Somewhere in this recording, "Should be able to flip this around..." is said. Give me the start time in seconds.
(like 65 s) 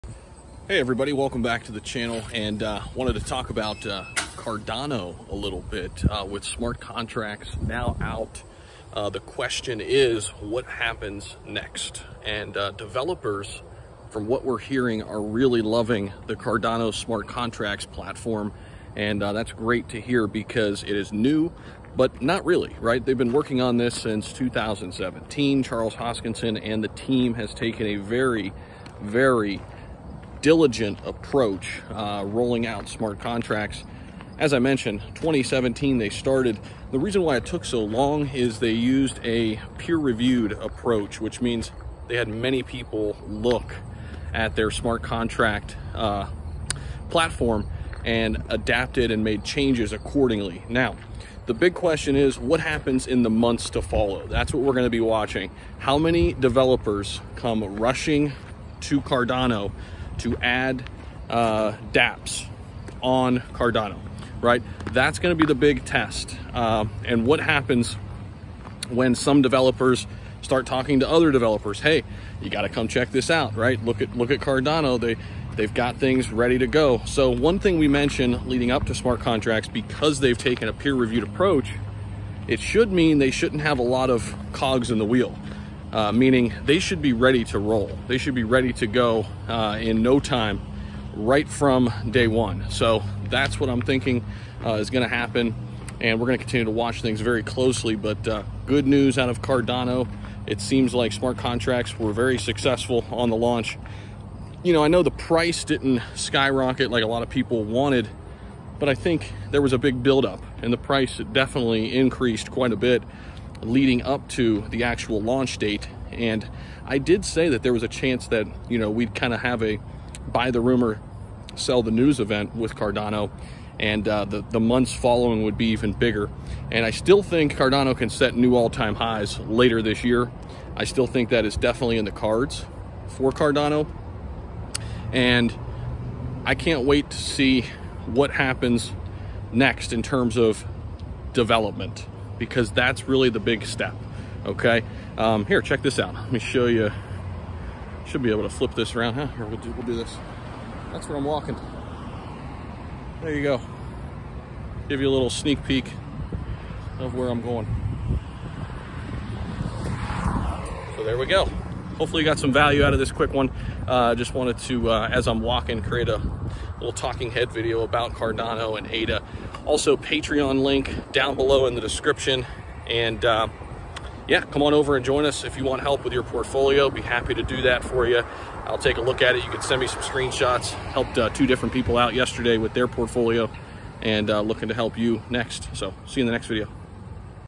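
148 s.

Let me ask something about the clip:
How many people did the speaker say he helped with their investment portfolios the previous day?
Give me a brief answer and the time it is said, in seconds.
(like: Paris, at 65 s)
2, at 181 s.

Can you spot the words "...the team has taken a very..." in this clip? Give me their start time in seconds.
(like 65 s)
26 s.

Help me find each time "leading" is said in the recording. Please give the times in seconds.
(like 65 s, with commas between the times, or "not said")
78 s, 113 s.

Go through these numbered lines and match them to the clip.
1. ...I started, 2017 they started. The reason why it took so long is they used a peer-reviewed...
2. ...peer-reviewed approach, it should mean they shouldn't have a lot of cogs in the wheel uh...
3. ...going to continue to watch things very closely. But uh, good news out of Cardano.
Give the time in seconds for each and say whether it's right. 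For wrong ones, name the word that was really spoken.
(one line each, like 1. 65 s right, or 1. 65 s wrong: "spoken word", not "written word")
1. 34 s wrong: "mentioned", not "started"
2. 80 s right
3. 96 s right.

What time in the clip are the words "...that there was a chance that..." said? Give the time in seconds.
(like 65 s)
117 s.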